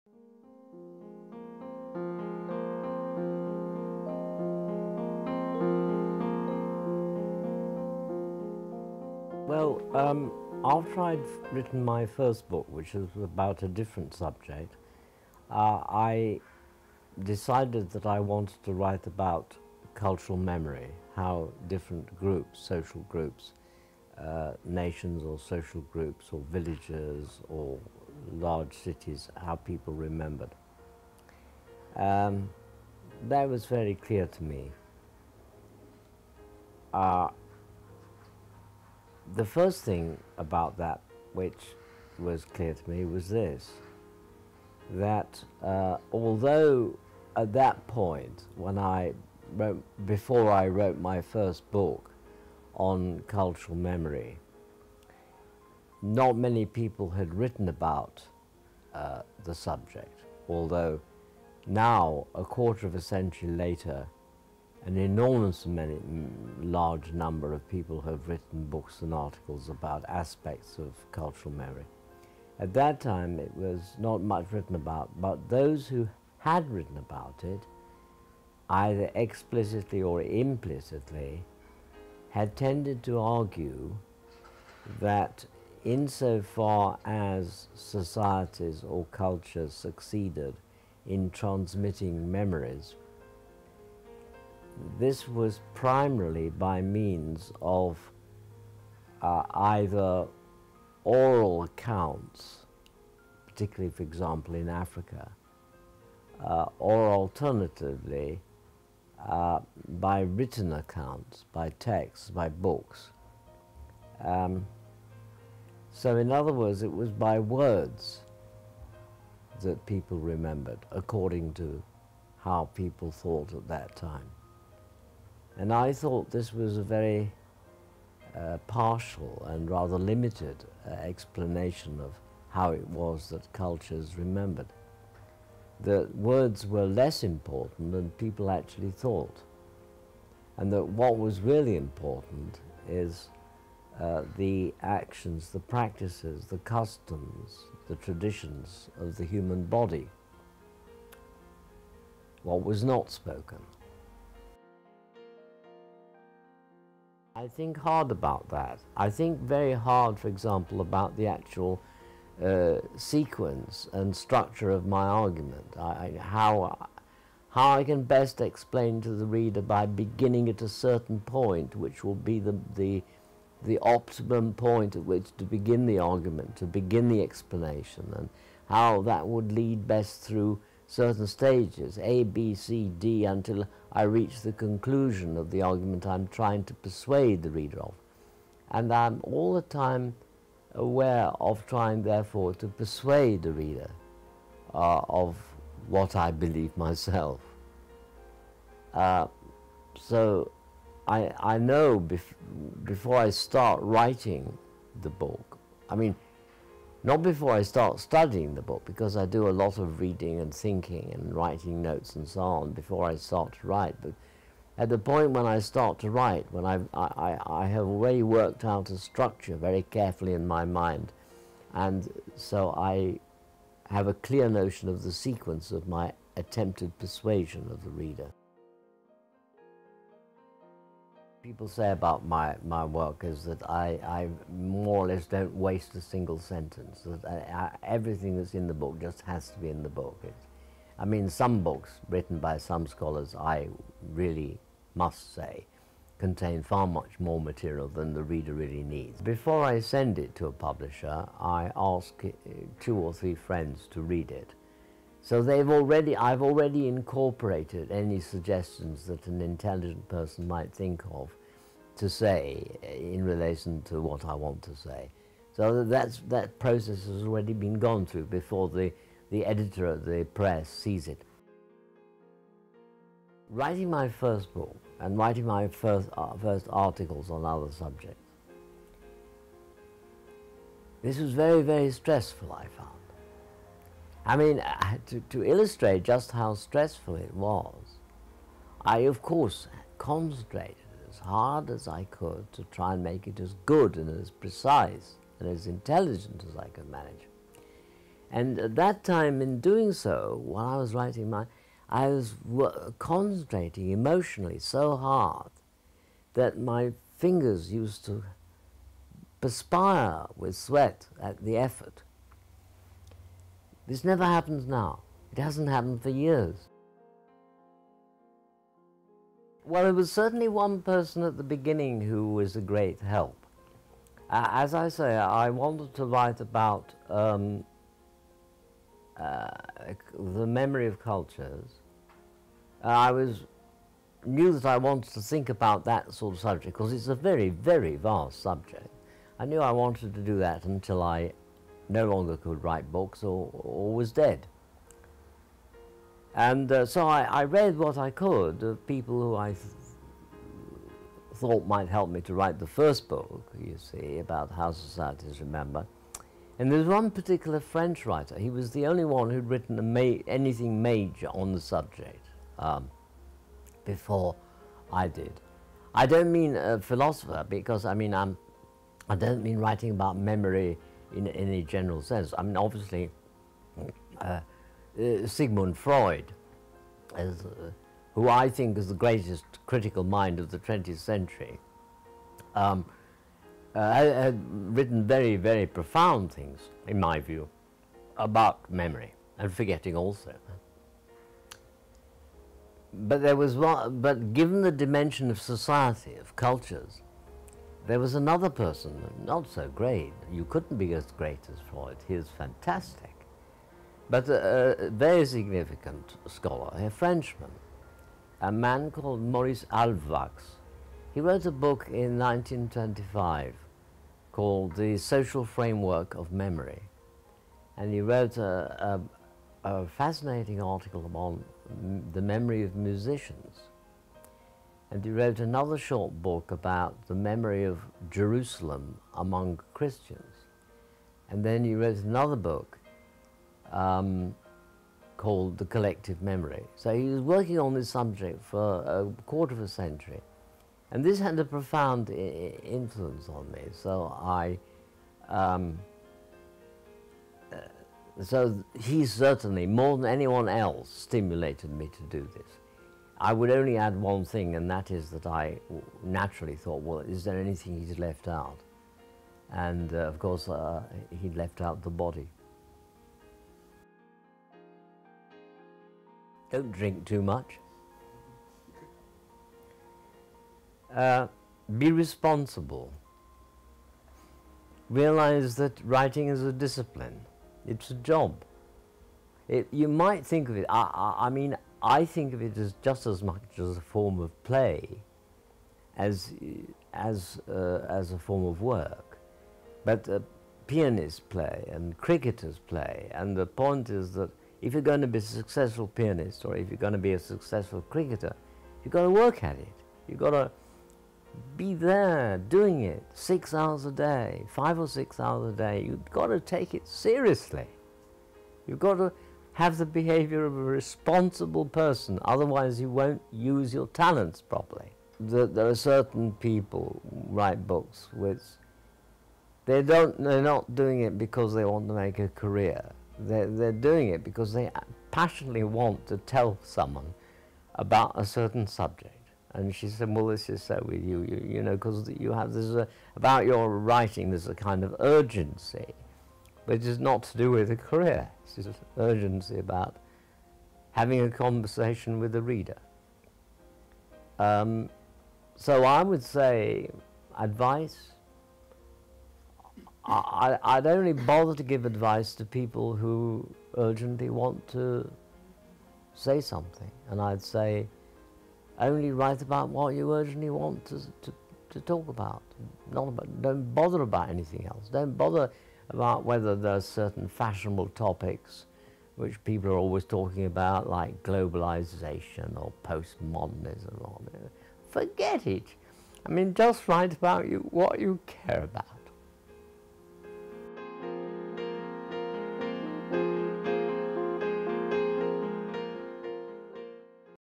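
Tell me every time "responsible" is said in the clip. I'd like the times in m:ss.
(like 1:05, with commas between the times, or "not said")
7:51, 8:30.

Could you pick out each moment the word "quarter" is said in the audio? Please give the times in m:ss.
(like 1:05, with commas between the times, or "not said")
1:02, 7:19.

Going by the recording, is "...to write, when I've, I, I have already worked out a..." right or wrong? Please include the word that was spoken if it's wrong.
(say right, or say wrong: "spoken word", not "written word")
right.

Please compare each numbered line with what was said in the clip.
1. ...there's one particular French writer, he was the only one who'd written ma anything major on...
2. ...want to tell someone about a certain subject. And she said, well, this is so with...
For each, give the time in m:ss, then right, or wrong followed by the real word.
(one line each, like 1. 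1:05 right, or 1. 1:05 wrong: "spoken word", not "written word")
1. 5:56 right
2. 8:45 right.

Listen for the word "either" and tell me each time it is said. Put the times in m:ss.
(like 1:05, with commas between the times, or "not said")
1:18, 1:39.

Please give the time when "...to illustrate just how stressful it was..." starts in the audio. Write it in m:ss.
4:45.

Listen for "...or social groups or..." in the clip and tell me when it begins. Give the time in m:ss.
0:25.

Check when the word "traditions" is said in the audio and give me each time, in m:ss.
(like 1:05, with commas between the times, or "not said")
2:27.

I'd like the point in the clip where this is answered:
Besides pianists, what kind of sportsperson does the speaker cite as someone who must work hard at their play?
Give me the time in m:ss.
8:11.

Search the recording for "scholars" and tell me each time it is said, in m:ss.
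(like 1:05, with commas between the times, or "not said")
4:02, 6:46.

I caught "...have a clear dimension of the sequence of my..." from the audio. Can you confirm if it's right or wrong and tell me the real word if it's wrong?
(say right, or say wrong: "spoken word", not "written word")
wrong: "notion", not "dimension".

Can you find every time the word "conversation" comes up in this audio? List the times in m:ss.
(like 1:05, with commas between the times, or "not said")
9:01.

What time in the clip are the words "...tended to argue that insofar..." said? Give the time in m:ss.
1:22.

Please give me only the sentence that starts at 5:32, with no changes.
Uh, I was knew that I wanted to think about that sort of subject because it's a very, very vast subject.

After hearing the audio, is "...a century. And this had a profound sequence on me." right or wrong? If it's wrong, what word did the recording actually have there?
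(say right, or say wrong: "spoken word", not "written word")
wrong: "influence", not "sequence".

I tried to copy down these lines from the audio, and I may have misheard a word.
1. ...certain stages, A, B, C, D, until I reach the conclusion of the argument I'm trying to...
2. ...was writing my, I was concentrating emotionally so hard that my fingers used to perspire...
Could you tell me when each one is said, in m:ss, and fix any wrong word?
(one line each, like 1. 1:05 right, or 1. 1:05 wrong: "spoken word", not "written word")
1. 3:00 right
2. 5:00 right.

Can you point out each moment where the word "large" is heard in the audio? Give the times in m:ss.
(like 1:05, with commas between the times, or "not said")
0:28, 1:06.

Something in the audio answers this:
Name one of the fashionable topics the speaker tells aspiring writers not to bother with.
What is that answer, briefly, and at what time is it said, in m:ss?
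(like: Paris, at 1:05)
Globalization, at 9:31.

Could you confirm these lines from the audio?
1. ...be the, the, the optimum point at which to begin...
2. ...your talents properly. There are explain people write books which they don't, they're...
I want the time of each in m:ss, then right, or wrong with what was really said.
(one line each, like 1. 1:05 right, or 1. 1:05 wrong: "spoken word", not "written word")
1. 2:52 right
2. 8:33 wrong: "certain", not "explain".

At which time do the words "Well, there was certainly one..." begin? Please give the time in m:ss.
5:19.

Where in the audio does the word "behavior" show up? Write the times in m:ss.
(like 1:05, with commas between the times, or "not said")
8:29.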